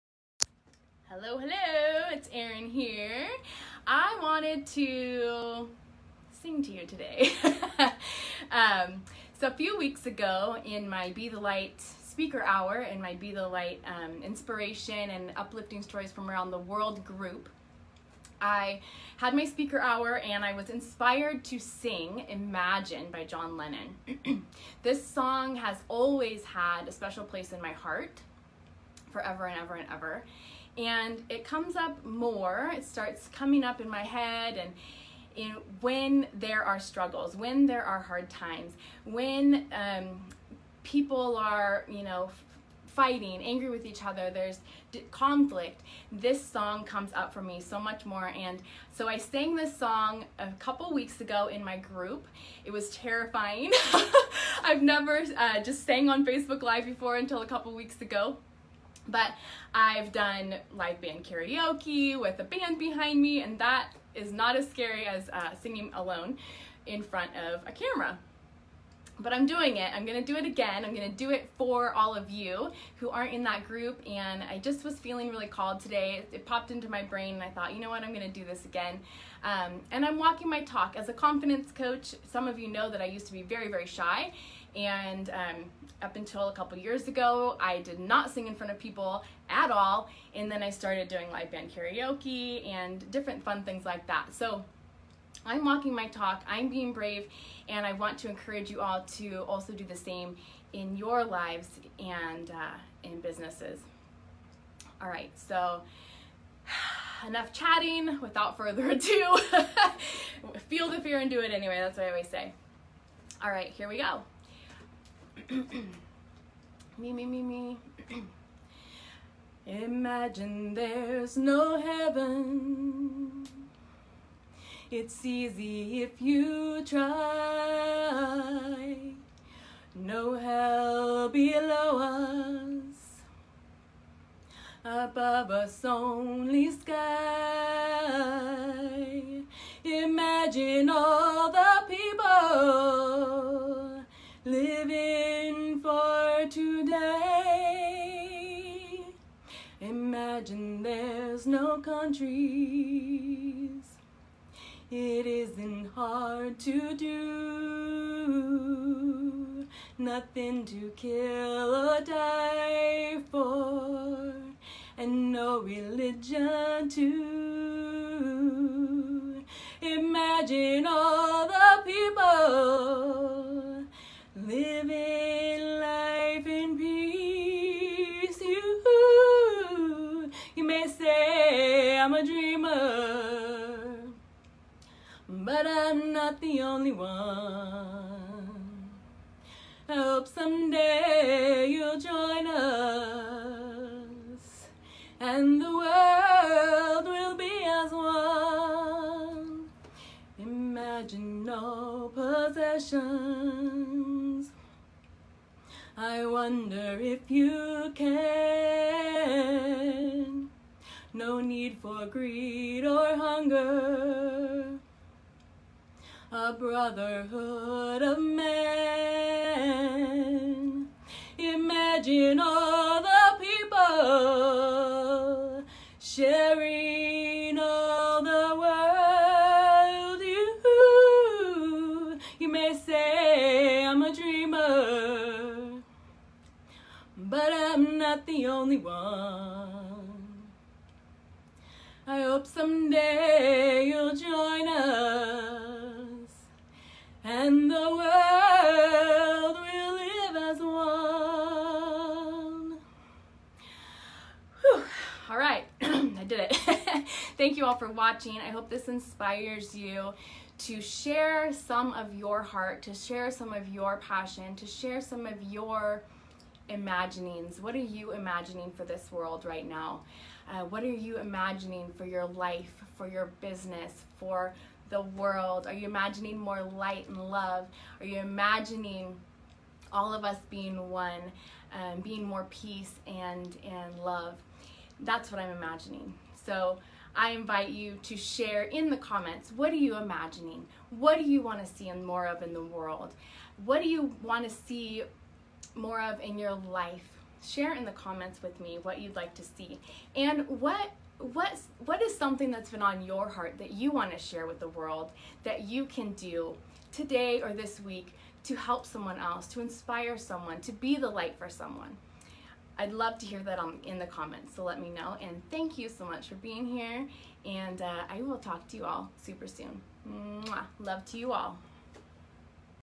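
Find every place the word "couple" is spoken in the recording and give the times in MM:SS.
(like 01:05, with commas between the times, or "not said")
00:50, 00:57, 01:26.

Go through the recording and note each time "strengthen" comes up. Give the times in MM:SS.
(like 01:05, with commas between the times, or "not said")
not said.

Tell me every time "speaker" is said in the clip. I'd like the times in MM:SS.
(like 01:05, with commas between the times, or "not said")
00:11, 00:19.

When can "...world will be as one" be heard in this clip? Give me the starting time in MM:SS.
03:15.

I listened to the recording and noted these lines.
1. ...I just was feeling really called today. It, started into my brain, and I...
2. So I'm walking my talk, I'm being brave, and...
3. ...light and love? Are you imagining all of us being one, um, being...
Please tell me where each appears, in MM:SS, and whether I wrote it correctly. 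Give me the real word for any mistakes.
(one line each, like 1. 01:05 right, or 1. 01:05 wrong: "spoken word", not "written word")
1. 01:14 wrong: "popped", not "started"
2. 01:34 right
3. 04:36 right.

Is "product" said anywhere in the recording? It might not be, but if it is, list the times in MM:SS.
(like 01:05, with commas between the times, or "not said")
not said.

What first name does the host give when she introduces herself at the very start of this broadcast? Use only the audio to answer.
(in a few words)
Erin.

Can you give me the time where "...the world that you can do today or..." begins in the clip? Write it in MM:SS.
05:04.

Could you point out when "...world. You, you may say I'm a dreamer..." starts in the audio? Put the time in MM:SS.
03:48.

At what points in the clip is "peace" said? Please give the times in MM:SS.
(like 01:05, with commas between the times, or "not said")
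02:56, 04:42.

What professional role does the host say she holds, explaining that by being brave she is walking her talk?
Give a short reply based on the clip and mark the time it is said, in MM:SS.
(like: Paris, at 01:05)
Confidence coach, at 01:21.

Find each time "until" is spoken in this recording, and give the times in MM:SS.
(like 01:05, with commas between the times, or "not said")
00:57, 01:26.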